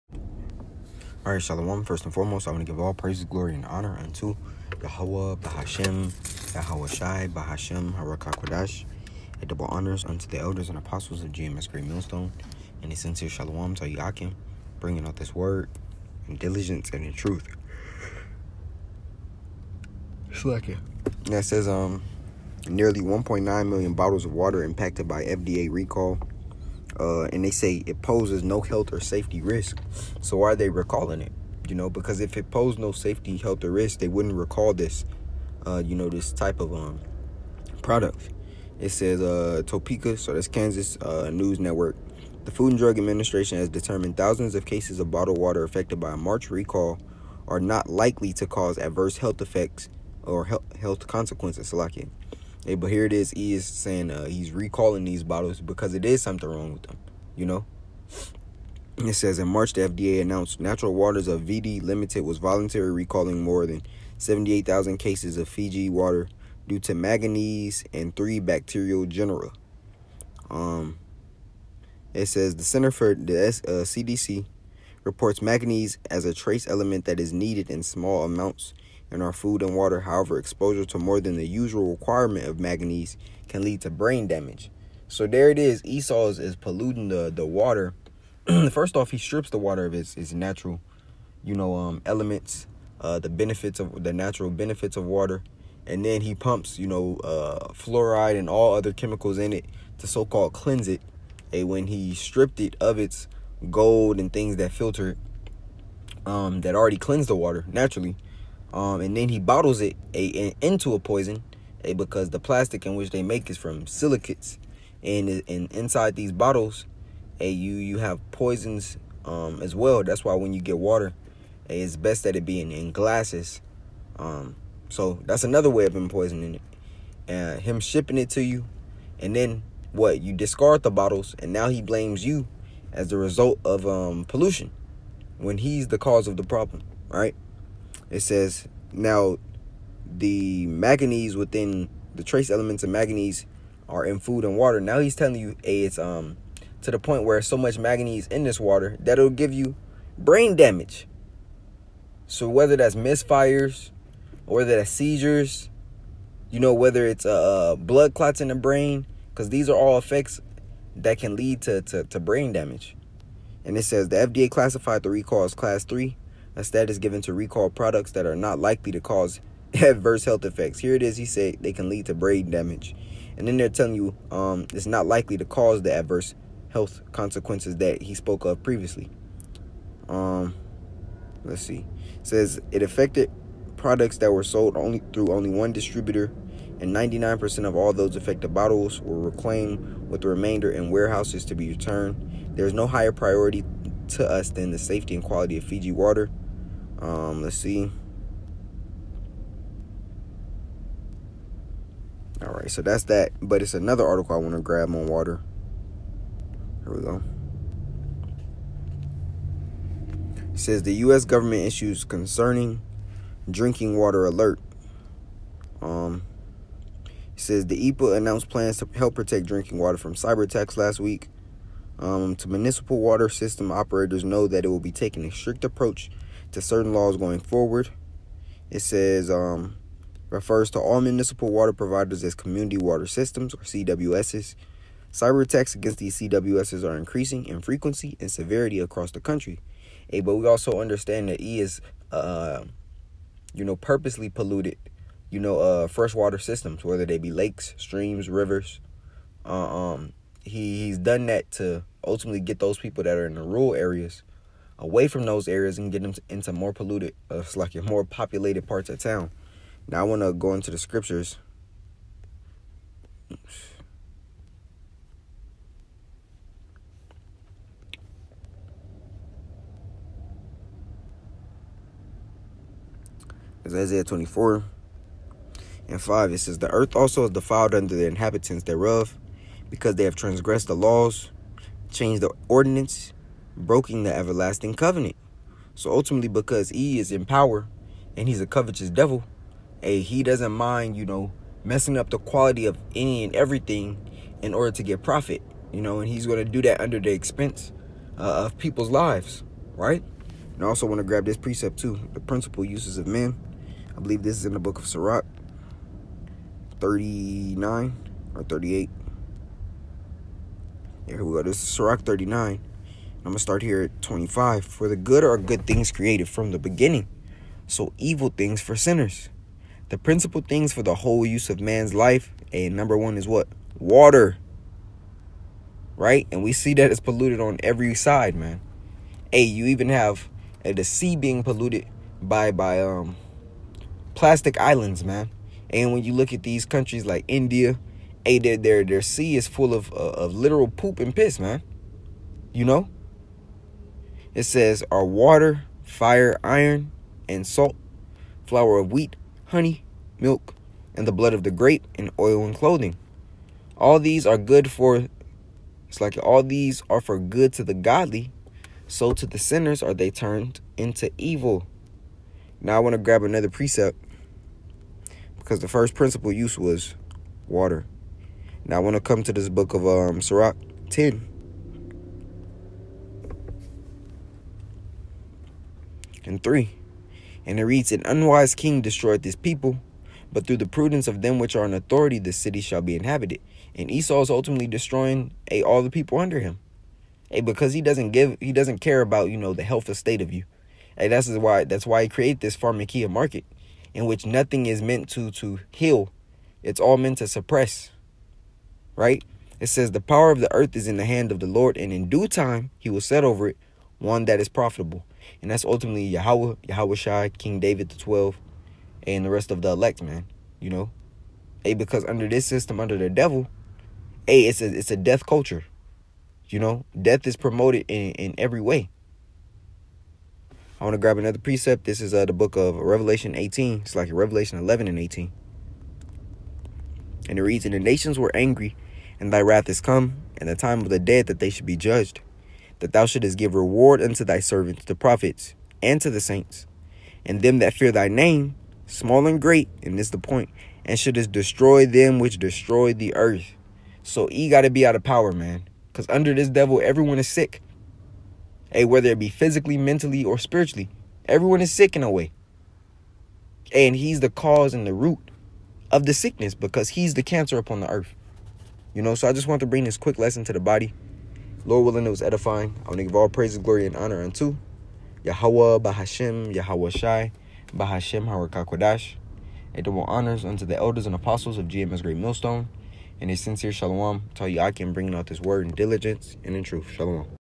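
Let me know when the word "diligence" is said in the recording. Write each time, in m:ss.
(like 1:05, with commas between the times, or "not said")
0:16, 7:55.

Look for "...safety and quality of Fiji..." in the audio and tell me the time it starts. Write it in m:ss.
3:14.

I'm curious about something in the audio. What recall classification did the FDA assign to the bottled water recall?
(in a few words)
Class three.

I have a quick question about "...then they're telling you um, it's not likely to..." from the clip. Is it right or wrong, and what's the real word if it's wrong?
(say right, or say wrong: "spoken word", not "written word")
right.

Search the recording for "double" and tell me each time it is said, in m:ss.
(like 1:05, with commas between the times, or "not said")
0:09, 7:49.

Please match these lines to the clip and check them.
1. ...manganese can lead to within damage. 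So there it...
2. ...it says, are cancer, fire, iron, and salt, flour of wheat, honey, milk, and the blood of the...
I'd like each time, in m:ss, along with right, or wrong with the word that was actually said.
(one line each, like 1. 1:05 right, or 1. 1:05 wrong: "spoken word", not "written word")
1. 1:22 wrong: "brain", not "within"
2. 5:44 wrong: "water", not "cancer".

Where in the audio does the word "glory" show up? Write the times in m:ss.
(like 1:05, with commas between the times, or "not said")
0:03, 7:43.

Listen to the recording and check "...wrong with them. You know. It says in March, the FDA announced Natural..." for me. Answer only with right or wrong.
right.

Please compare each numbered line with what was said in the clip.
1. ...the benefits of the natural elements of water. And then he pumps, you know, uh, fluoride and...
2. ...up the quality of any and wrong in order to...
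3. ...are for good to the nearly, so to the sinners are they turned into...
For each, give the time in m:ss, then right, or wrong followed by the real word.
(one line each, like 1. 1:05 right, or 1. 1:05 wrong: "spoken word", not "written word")
1. 1:33 wrong: "benefits", not "elements"
2. 4:51 wrong: "everything", not "wrong"
3. 5:56 wrong: "godly", not "nearly".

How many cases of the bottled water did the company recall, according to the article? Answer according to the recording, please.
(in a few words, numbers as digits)
78,000.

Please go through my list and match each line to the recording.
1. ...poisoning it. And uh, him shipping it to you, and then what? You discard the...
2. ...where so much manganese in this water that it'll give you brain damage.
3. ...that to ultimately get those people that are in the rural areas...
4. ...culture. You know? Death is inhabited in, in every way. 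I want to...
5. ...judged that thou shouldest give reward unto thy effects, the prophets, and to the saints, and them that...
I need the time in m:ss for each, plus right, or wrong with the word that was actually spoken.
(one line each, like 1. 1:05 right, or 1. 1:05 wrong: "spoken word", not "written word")
1. 2:06 right
2. 2:27 right
3. 4:11 right
4. 6:55 wrong: "promoted", not "inhabited"
5. 7:11 wrong: "servants", not "effects".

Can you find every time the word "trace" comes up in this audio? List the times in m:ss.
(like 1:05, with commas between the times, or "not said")
1:16, 2:22.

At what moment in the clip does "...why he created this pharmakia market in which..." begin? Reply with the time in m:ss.
6:31.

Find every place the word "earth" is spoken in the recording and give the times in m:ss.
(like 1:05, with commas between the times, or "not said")
4:36, 6:40, 7:23, 7:37.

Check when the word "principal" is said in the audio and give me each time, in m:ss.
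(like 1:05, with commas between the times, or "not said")
5:02, 5:19, 6:05.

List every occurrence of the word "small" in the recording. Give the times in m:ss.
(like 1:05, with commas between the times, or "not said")
1:17, 7:18.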